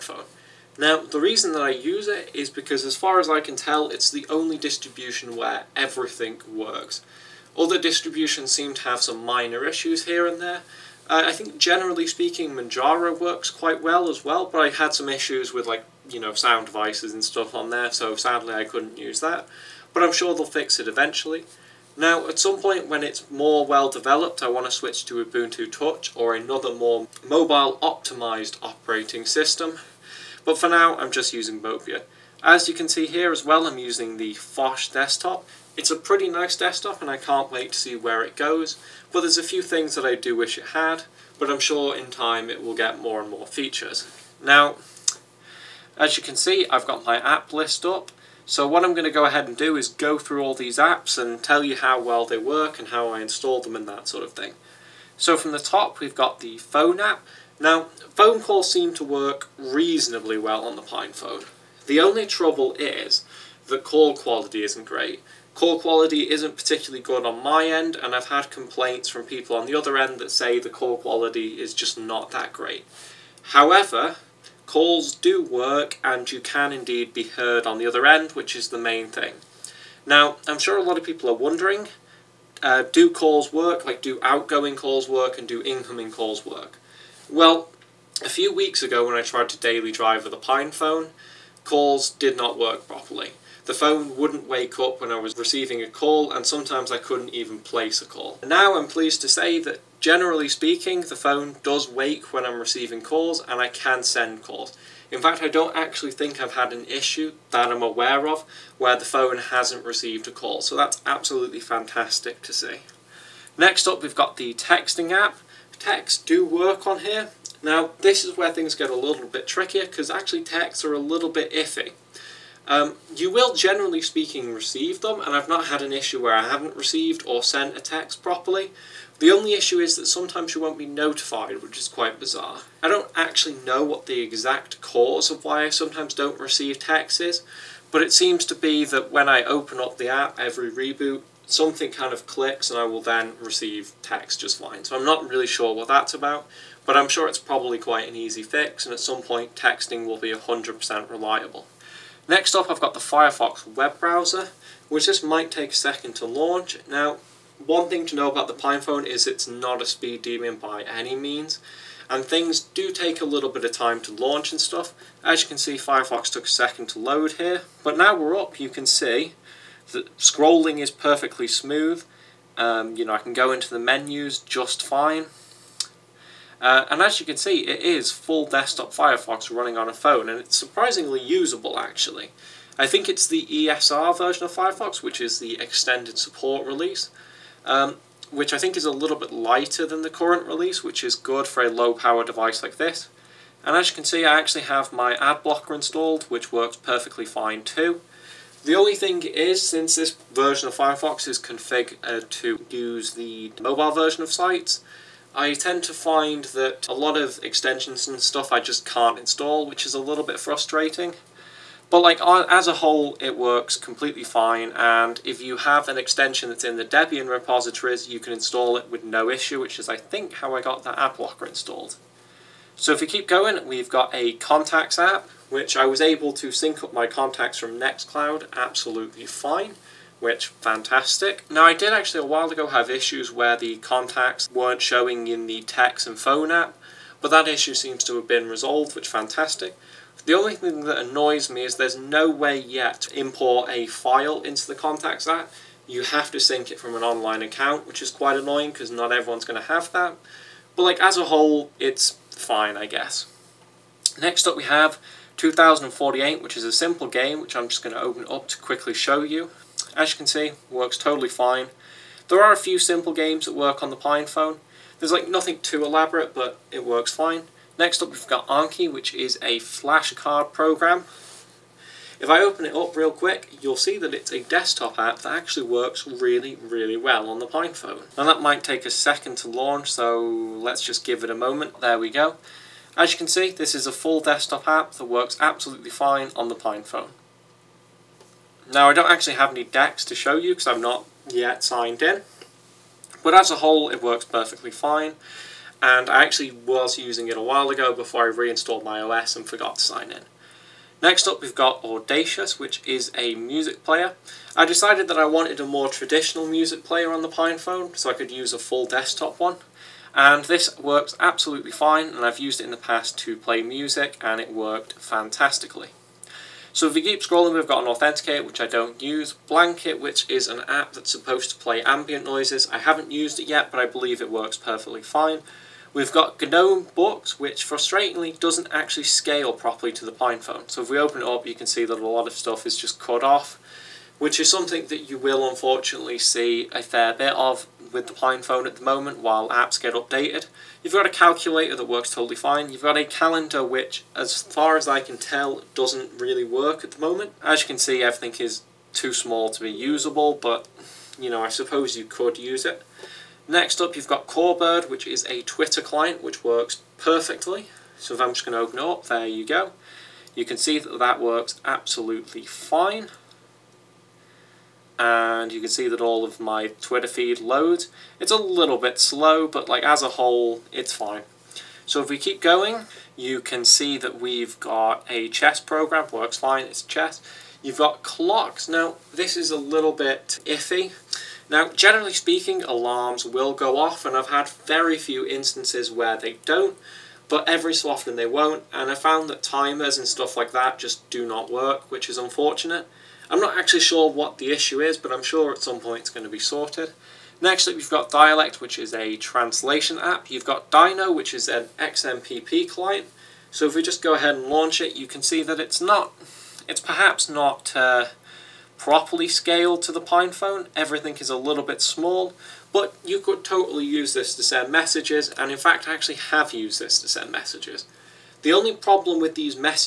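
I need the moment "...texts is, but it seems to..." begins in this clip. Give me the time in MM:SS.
02:16.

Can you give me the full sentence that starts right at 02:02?
Um, you will, generally speaking, receive them, and I've not had an issue where I haven't received or sent a text properly.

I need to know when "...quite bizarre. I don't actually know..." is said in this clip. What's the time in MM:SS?
02:11.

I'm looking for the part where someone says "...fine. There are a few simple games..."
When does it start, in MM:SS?
04:21.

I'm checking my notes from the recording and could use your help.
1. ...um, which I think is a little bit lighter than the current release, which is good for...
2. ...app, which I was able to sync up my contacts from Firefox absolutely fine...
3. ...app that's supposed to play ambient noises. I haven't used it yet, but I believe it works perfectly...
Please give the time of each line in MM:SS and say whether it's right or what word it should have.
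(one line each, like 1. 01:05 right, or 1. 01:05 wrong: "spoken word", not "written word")
1. 03:07 right
2. 03:44 wrong: "Nextcloud", not "Firefox"
3. 05:20 right.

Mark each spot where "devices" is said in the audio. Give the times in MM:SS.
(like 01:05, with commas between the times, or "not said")
00:16, 03:12.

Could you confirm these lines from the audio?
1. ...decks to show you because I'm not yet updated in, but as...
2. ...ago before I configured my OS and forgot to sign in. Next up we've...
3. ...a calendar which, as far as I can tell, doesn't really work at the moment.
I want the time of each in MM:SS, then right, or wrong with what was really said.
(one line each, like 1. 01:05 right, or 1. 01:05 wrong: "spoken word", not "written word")
1. 04:49 wrong: "signed", not "updated"
2. 04:57 wrong: "reinstalled", not "configured"
3. 05:42 right.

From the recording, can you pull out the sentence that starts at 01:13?
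However, calls do work, and you can indeed be heard on the other end, which is the main thing.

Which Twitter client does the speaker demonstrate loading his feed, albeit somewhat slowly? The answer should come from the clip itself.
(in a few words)
Corebird.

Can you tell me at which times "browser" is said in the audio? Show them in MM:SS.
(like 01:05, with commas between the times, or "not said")
02:33.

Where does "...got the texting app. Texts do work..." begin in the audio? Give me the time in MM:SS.
01:54.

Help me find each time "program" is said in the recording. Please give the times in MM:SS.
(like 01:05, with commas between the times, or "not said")
04:30, 06:15.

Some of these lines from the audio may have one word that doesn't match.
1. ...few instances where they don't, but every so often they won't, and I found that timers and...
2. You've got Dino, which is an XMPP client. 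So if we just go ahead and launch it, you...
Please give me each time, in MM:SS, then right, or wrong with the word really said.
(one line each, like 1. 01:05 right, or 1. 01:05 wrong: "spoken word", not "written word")
1. 06:24 right
2. 06:40 right.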